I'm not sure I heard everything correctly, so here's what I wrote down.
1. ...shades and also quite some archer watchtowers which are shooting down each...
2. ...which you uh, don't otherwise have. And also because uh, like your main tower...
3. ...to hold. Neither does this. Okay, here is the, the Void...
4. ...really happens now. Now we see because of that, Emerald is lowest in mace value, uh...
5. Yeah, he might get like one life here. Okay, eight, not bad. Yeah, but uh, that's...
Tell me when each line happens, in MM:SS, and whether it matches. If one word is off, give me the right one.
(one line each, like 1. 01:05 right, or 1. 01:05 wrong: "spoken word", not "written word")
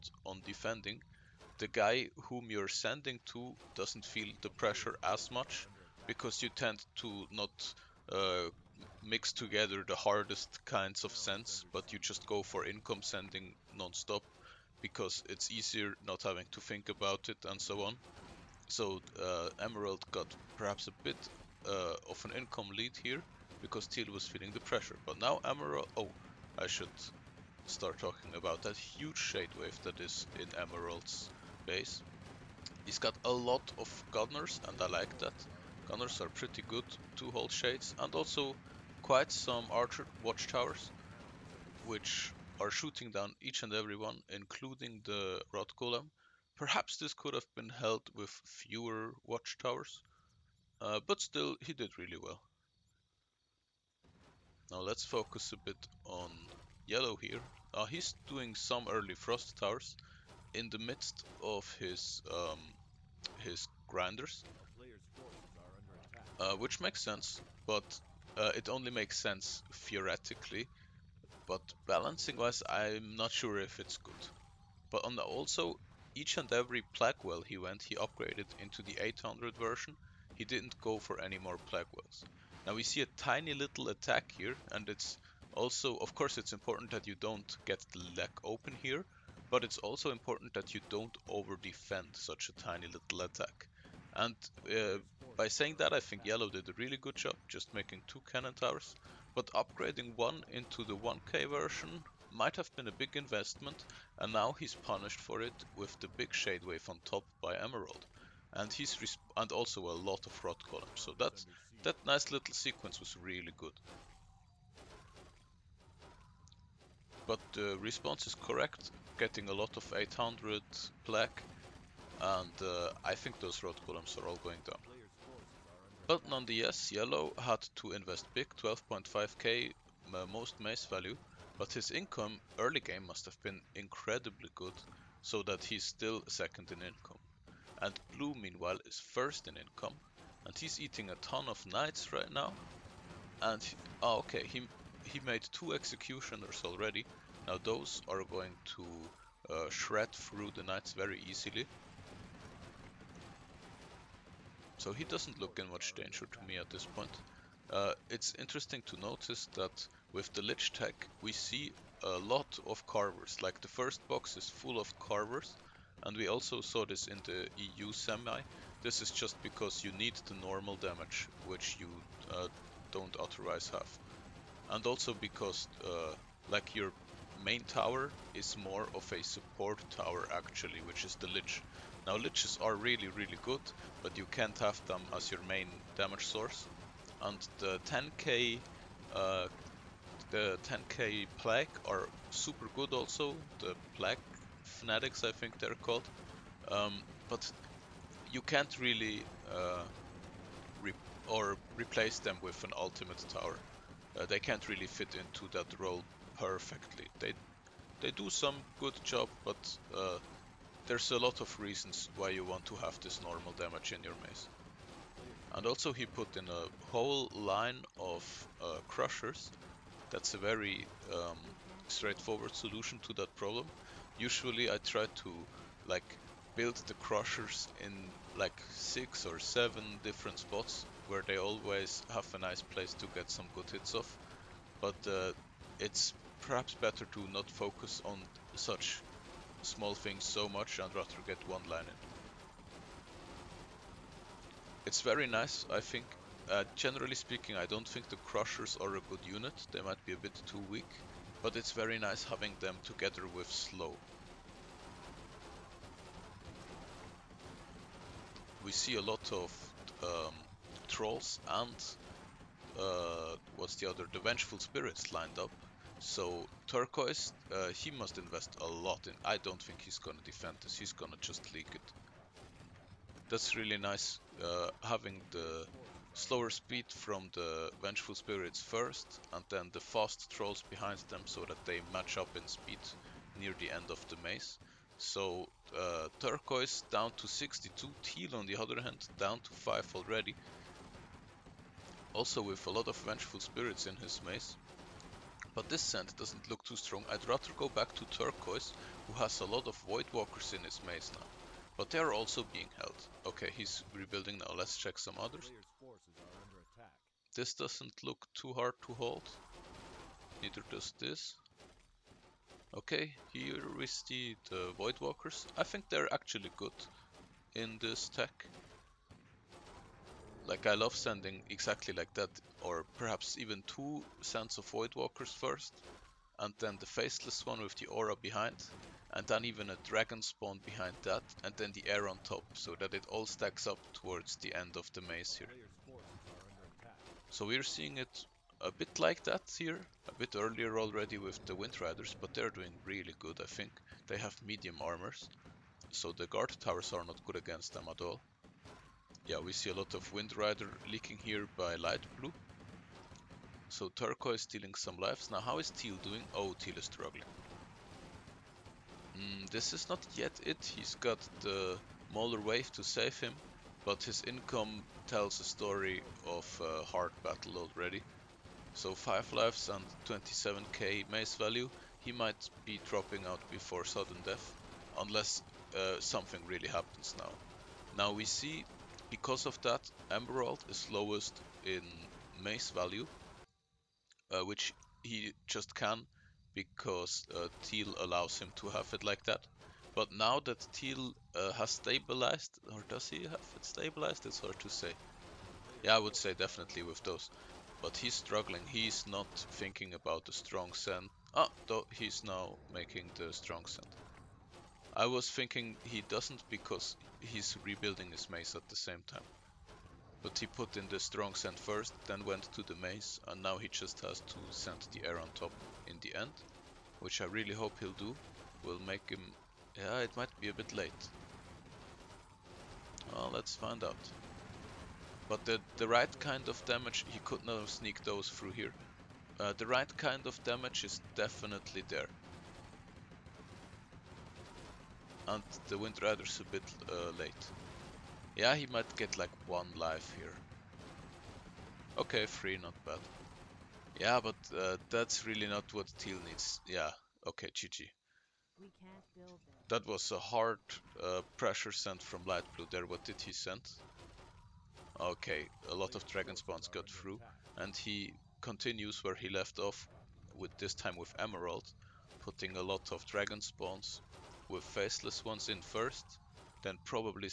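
1. 00:37 right
2. 02:51 right
3. 05:08 right
4. 06:16 right
5. 07:18 wrong: "three", not "eight".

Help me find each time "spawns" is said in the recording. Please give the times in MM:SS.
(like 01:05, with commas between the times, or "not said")
05:30, 07:36, 07:43.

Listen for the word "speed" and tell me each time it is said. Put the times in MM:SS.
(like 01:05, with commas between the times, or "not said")
04:36, 04:42.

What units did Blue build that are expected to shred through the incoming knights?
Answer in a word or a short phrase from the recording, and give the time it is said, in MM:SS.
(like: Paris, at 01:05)
Executioners, at 02:25.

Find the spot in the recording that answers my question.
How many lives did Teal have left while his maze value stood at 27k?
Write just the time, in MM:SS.
06:08.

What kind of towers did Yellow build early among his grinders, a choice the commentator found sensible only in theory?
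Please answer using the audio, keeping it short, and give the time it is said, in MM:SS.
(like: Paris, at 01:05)
Frost towers, at 00:59.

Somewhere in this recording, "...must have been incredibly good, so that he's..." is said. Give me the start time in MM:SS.
02:13.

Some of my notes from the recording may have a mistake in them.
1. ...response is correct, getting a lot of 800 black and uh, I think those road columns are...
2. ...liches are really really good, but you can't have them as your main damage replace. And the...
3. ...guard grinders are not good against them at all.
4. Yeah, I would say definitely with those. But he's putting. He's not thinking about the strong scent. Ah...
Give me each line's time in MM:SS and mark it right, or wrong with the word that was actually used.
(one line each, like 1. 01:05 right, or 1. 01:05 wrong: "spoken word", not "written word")
1. 01:57 right
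2. 03:02 wrong: "source", not "replace"
3. 05:46 wrong: "towers", not "grinders"
4. 06:35 wrong: "struggling", not "putting".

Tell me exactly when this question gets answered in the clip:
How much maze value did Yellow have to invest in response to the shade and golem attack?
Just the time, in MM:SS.
02:08.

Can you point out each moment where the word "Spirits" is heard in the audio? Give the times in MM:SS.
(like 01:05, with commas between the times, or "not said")
04:24, 04:38, 04:53.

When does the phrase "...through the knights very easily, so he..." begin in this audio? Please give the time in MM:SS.
02:30.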